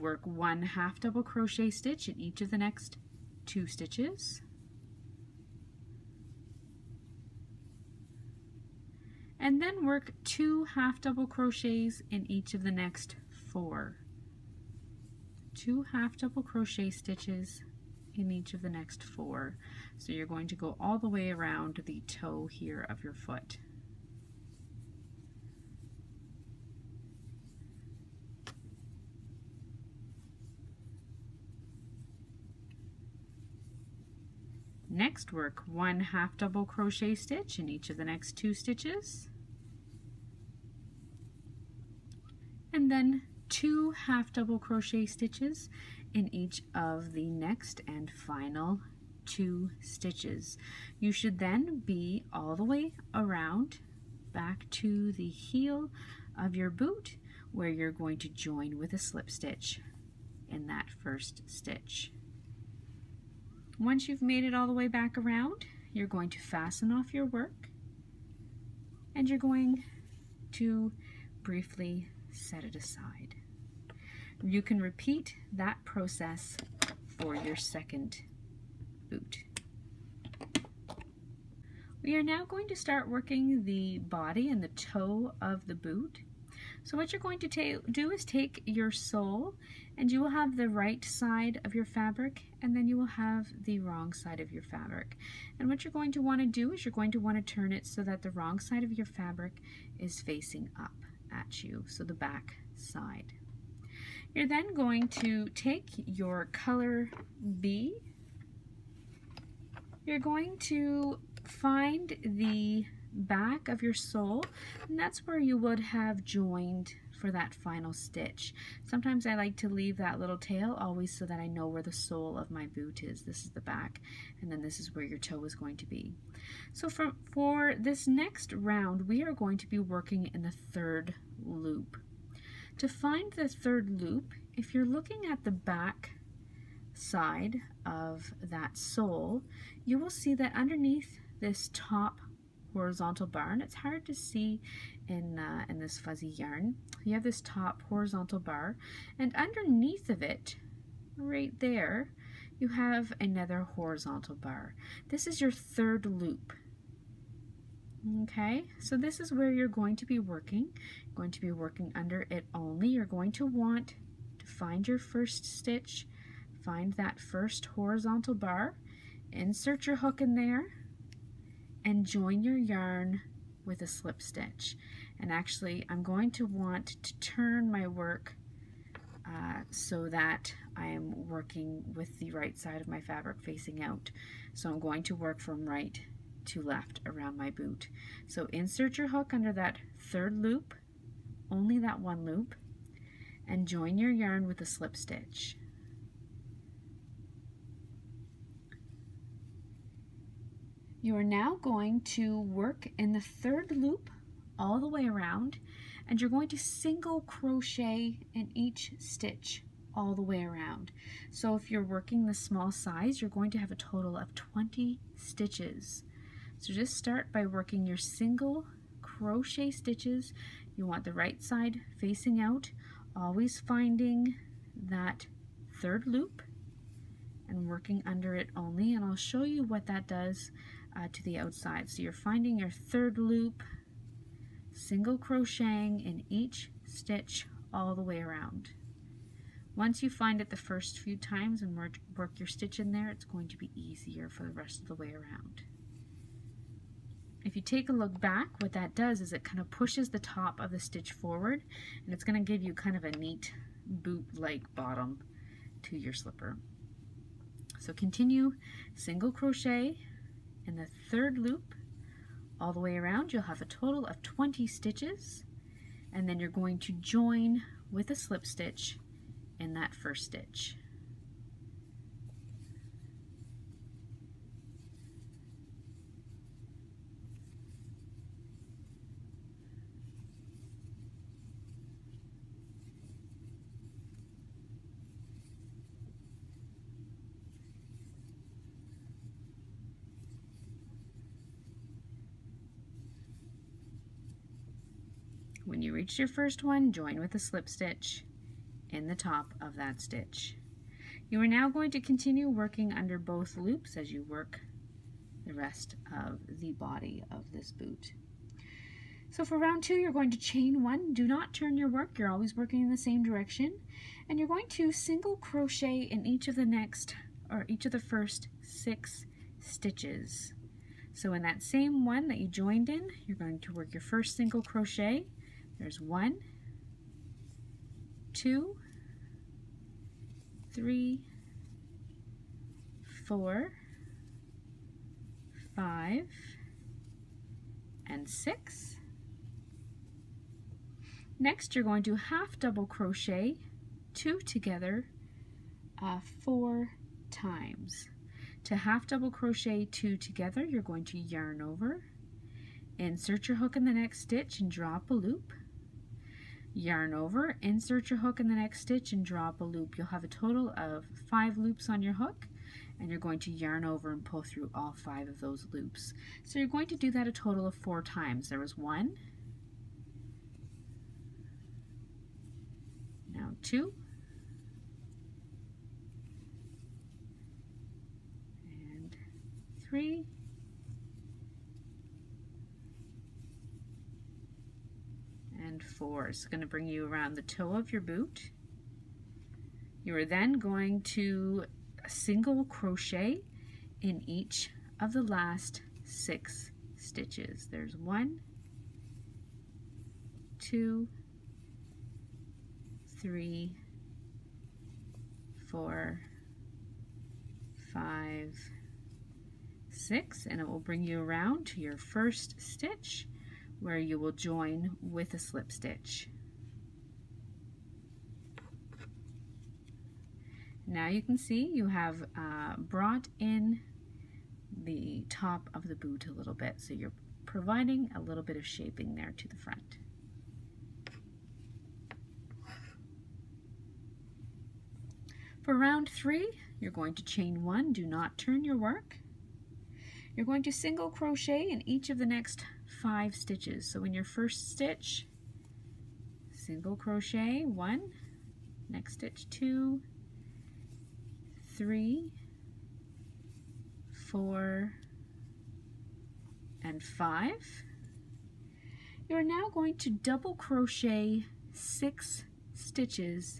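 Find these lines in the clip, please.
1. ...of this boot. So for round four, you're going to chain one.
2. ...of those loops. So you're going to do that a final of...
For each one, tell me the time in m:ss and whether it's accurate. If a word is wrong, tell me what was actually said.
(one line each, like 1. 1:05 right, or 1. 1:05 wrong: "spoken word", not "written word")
1. 5:07 wrong: "two", not "four"
2. 6:05 wrong: "total", not "final".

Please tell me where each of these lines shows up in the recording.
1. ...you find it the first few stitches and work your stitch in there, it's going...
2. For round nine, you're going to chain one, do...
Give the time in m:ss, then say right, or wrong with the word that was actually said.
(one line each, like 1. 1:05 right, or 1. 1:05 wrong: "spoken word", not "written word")
1. 4:00 wrong: "times", not "stitches"
2. 7:15 wrong: "three", not "nine".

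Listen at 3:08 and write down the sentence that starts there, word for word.
So insert your hook under that third loop, only that one loop, and join your yarn with a slip stitch.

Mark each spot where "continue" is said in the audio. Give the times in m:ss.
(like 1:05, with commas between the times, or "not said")
4:17, 5:02.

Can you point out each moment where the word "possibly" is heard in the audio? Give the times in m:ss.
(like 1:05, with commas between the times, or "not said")
not said.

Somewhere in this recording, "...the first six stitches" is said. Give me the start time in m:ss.
5:17.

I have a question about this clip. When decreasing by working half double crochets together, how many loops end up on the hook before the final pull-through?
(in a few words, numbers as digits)
5.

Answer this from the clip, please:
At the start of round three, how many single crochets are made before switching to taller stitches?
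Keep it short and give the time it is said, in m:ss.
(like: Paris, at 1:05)
5, at 7:21.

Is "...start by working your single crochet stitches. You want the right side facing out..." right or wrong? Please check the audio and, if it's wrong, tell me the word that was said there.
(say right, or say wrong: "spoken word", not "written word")
right.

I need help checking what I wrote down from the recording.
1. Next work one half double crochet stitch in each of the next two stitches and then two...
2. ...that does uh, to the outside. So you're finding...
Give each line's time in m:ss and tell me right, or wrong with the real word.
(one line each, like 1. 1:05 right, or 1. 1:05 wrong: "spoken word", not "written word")
1. 0:34 right
2. 3:49 right.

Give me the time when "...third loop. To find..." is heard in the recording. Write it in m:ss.
2:10.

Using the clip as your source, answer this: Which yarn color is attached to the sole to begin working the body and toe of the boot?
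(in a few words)
color B.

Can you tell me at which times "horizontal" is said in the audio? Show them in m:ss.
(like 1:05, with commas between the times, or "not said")
2:22, 2:27, 2:33, 2:47.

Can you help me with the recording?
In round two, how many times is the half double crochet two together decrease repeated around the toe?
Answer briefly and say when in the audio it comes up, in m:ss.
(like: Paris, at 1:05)
4, at 5:46.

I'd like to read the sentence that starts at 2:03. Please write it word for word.
This is the back and then this is where your toe is going to be.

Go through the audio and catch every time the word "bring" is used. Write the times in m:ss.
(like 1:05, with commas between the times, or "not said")
6:26, 6:50.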